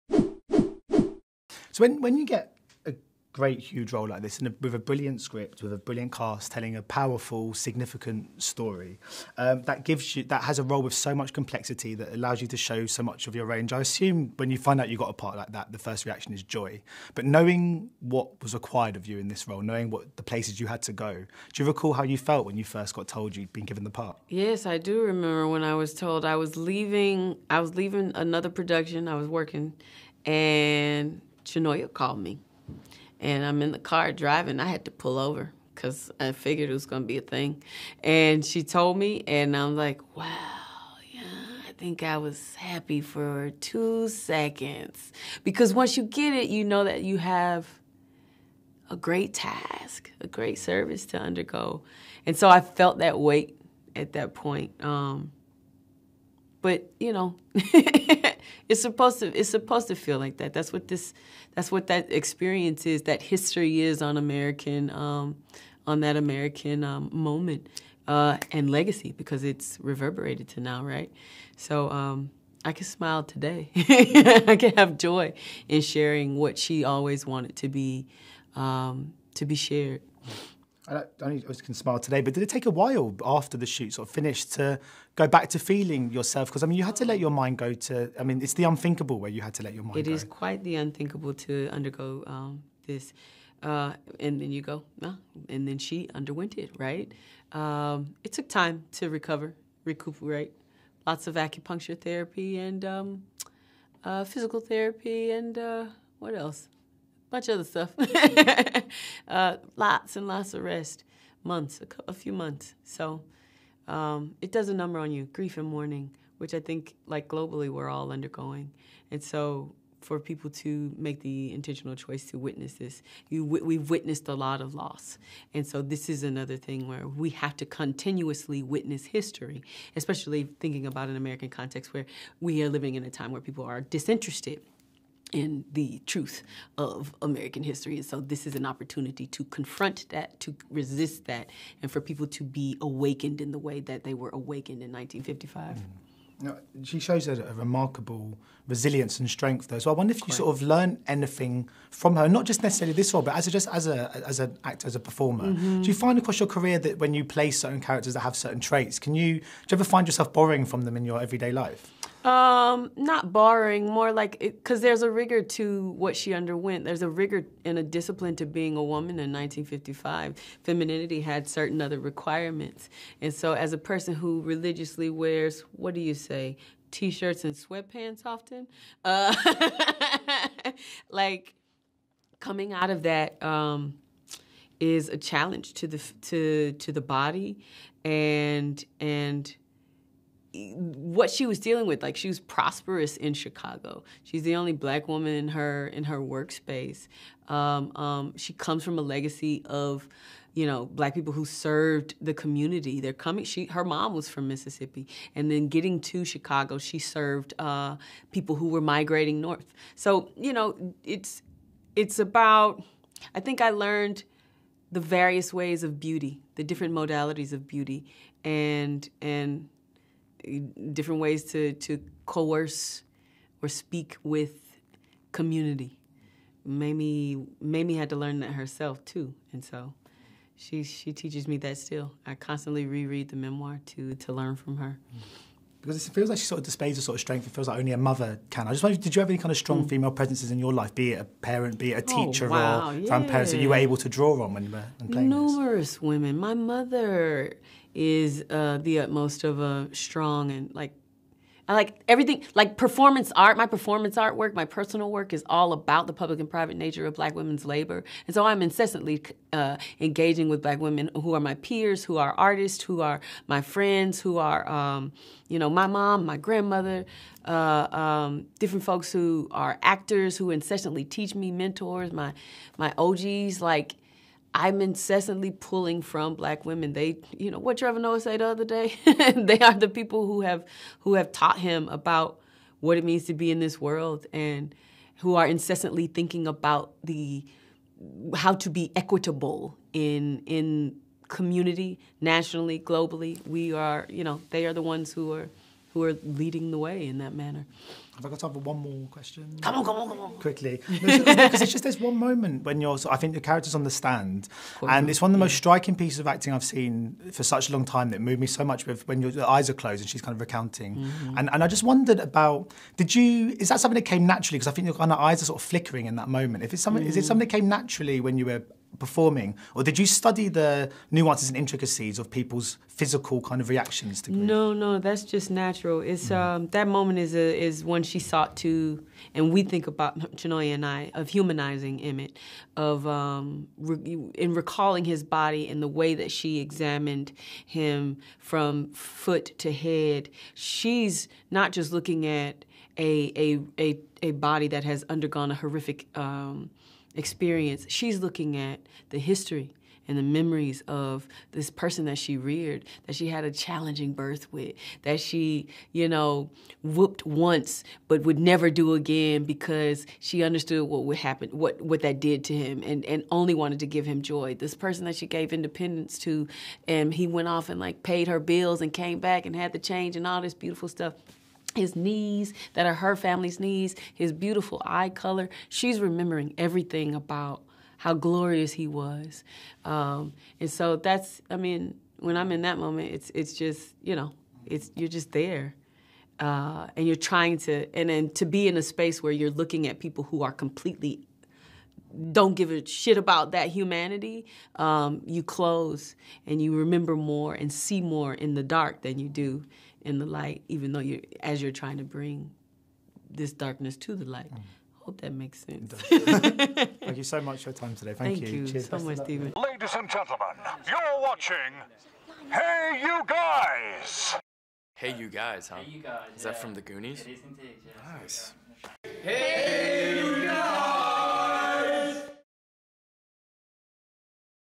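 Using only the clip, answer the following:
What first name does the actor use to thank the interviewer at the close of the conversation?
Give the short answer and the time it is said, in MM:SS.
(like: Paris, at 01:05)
Stephen, at 06:49.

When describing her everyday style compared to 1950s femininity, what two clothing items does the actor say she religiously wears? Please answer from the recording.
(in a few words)
T-shirts and sweatpants.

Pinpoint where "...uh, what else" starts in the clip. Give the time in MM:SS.
01:45.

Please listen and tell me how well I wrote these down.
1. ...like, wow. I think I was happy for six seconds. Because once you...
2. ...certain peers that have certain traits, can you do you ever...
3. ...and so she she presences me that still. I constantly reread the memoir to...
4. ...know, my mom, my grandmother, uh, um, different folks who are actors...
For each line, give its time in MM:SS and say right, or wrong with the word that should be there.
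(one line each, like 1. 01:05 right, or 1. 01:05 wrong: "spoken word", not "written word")
1. 00:39 wrong: "two", not "six"
2. 02:37 wrong: "characters", not "peers"
3. 03:49 wrong: "teaches", not "presences"
4. 04:25 right.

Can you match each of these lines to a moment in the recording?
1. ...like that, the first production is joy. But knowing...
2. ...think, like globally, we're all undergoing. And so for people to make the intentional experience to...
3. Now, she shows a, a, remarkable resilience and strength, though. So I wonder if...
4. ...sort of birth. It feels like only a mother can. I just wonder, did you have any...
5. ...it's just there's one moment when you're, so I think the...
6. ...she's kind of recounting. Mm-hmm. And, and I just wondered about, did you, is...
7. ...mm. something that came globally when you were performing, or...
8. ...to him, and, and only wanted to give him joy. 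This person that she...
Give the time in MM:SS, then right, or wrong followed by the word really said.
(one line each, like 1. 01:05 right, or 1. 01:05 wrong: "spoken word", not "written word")
1. 00:15 wrong: "reaction", not "production"
2. 01:56 wrong: "choice", not "experience"
3. 02:26 right
4. 03:57 wrong: "strength", not "birth"
5. 05:01 right
6. 05:10 right
7. 05:17 wrong: "naturally", not "globally"
8. 06:02 right.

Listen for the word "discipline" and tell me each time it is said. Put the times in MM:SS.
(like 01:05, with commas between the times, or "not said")
02:47.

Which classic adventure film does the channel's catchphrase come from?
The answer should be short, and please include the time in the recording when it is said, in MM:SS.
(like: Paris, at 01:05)
The Goonies, at 06:56.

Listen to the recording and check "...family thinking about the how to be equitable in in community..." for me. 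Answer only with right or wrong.
wrong.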